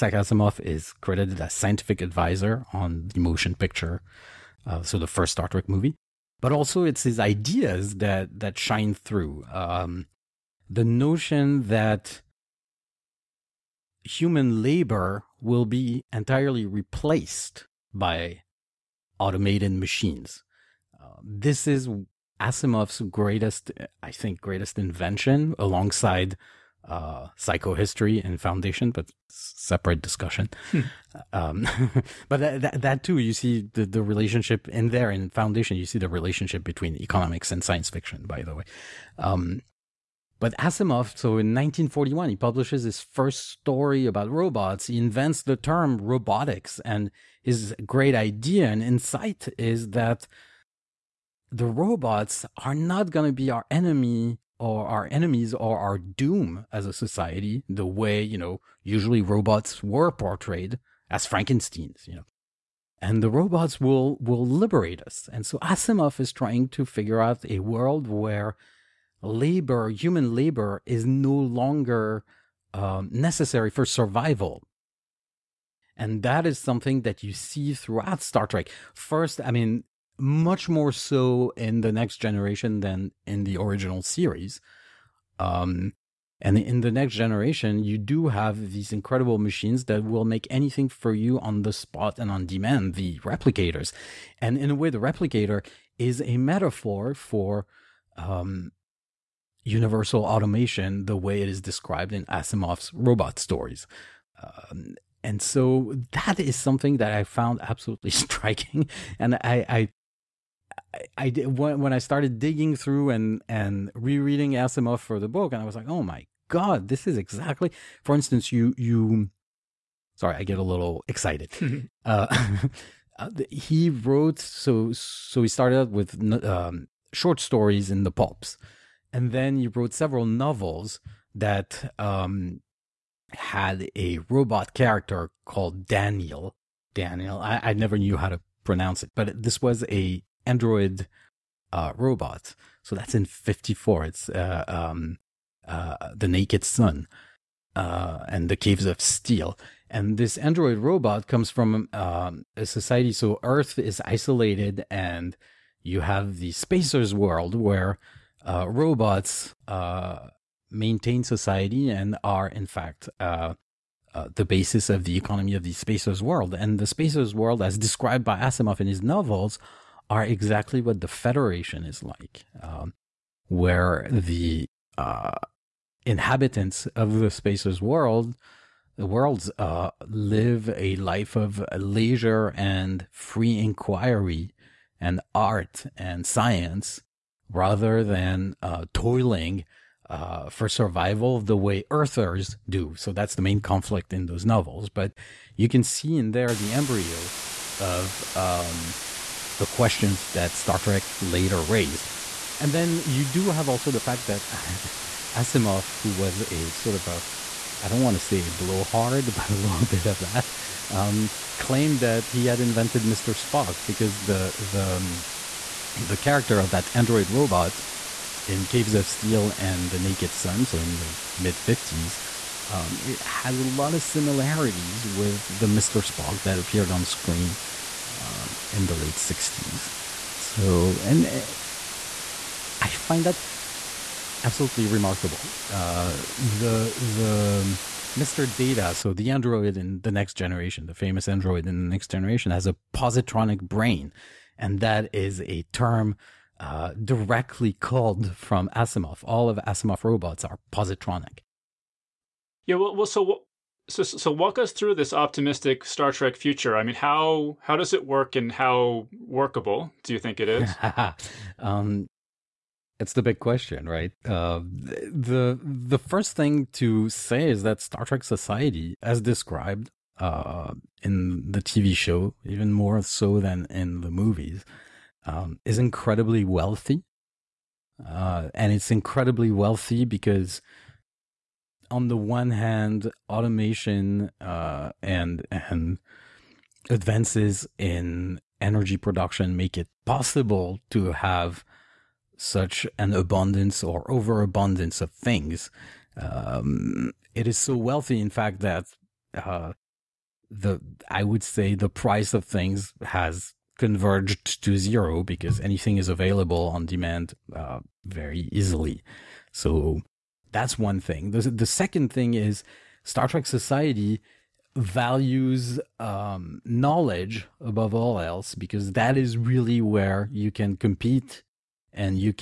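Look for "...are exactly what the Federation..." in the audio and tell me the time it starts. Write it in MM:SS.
02:50.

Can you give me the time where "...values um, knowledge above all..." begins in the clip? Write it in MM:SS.
05:14.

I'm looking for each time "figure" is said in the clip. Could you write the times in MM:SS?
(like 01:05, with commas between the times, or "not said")
01:06.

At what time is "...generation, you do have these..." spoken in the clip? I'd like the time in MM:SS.
01:27.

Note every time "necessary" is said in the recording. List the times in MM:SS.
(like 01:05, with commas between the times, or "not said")
01:13.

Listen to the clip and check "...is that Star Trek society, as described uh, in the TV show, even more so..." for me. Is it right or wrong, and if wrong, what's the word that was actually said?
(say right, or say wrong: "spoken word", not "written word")
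right.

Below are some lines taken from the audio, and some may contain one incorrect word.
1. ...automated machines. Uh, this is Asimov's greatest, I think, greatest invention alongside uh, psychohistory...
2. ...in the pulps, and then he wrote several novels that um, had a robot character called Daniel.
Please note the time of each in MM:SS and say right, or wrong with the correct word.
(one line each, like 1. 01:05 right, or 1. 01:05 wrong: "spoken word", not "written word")
1. 00:19 right
2. 02:07 right.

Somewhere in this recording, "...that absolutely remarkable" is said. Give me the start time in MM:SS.
03:53.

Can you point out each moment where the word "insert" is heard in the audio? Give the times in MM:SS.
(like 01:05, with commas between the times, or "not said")
not said.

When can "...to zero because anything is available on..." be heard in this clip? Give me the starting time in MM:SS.
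05:04.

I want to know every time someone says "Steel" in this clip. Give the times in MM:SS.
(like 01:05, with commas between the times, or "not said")
02:29, 03:39.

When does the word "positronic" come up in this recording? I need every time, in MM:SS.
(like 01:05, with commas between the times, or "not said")
04:02, 04:10.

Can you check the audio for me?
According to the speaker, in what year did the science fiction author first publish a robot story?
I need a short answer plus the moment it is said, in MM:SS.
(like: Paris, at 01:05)
1941, at 00:41.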